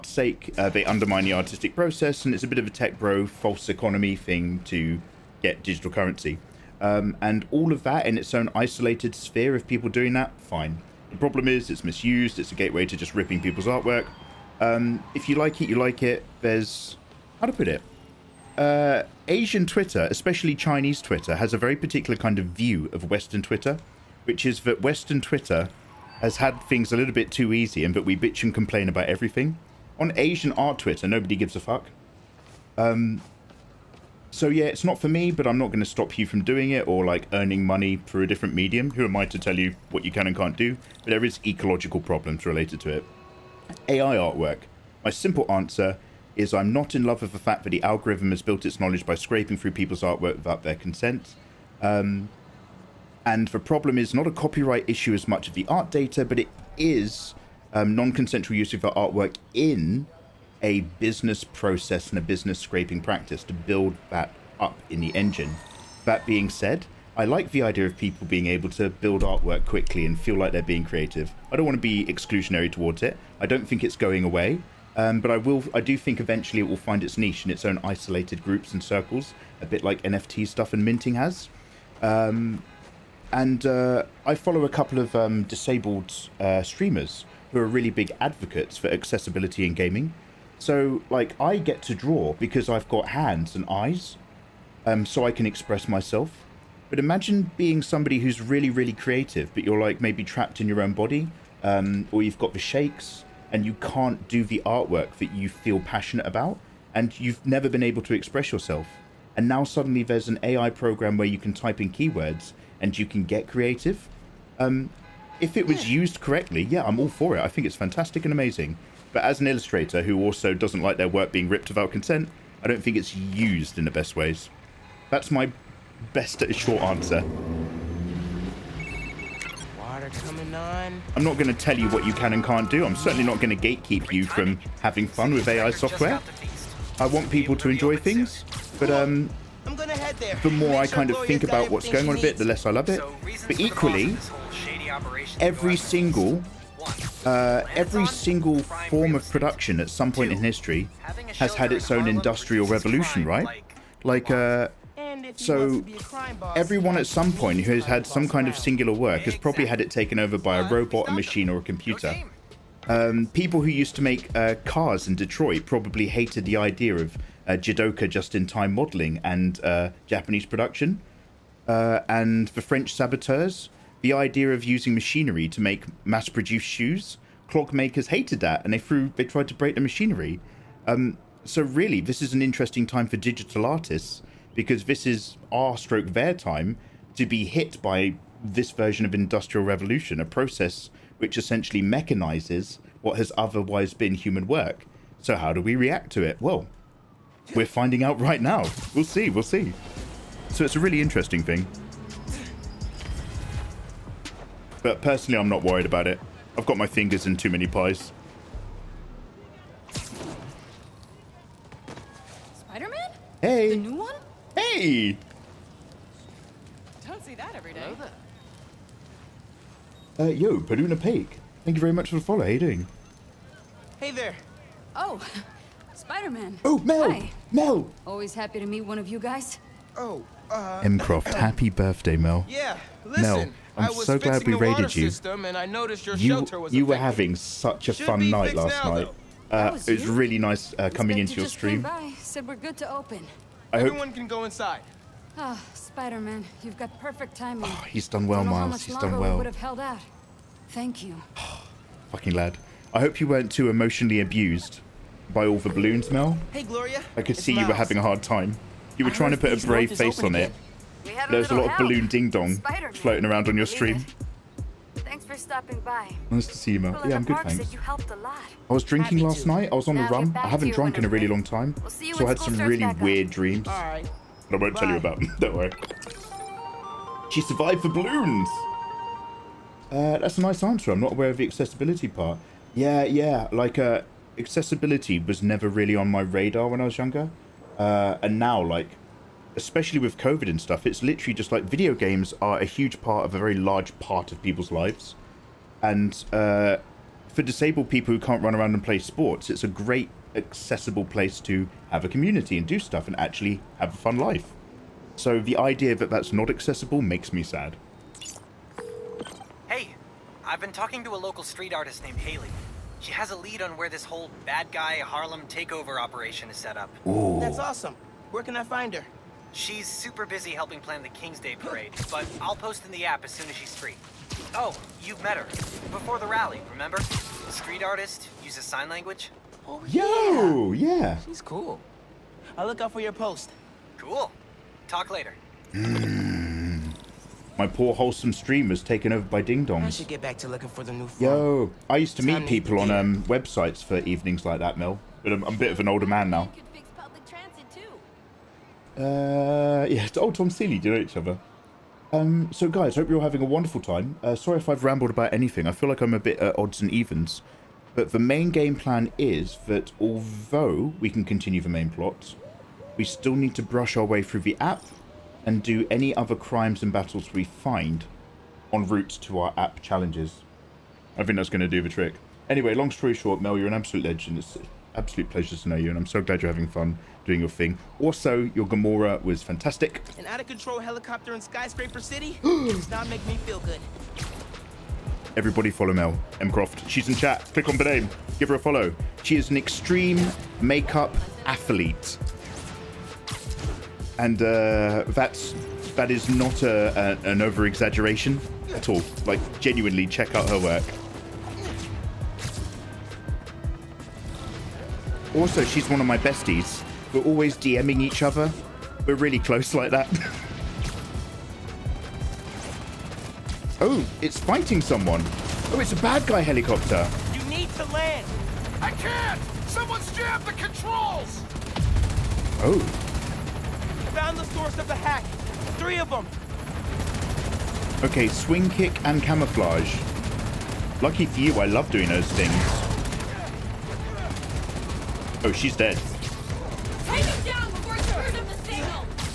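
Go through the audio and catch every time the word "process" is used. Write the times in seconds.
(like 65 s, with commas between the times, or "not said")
1 s, 61 s, 190 s.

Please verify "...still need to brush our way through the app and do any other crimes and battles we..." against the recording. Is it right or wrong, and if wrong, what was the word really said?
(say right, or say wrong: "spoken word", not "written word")
right.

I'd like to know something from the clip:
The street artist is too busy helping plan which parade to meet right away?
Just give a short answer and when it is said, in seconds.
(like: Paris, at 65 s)
King's Day parade, at 321 s.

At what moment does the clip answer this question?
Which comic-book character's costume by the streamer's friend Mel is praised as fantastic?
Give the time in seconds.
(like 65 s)
378 s.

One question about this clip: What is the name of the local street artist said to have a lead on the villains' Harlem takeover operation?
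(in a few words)
Hailey.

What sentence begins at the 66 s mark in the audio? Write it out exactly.
That being said, I like the idea of people being able to build artwork quickly and feel like they're being creative.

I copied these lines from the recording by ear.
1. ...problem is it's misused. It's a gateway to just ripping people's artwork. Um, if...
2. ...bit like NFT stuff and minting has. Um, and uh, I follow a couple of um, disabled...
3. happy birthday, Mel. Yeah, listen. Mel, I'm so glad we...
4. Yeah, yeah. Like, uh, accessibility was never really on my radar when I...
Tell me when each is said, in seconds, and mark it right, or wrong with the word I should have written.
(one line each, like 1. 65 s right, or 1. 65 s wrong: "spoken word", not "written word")
1. 11 s right
2. 79 s right
3. 231 s right
4. 282 s right.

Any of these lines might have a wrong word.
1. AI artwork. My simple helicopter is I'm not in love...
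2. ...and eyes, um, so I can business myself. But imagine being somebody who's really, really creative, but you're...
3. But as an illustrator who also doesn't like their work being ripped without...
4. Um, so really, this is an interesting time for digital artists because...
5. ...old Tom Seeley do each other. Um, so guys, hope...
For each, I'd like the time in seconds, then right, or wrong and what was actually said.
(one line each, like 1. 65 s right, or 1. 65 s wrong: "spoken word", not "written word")
1. 43 s wrong: "answer", not "helicopter"
2. 93 s wrong: "express", not "business"
3. 119 s right
4. 180 s right
5. 350 s right.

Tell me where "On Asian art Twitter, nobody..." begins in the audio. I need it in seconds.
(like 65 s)
29 s.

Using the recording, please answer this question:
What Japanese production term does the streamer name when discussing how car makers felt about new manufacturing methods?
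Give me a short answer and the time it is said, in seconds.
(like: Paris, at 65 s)
Jidoka, at 167 s.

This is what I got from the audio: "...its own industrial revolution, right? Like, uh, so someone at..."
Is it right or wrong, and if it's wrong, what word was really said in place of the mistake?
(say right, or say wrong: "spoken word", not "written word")
wrong: "everyone", not "someone".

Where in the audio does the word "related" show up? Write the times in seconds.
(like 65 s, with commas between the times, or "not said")
42 s.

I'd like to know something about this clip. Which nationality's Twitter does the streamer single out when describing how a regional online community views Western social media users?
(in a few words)
Chinese.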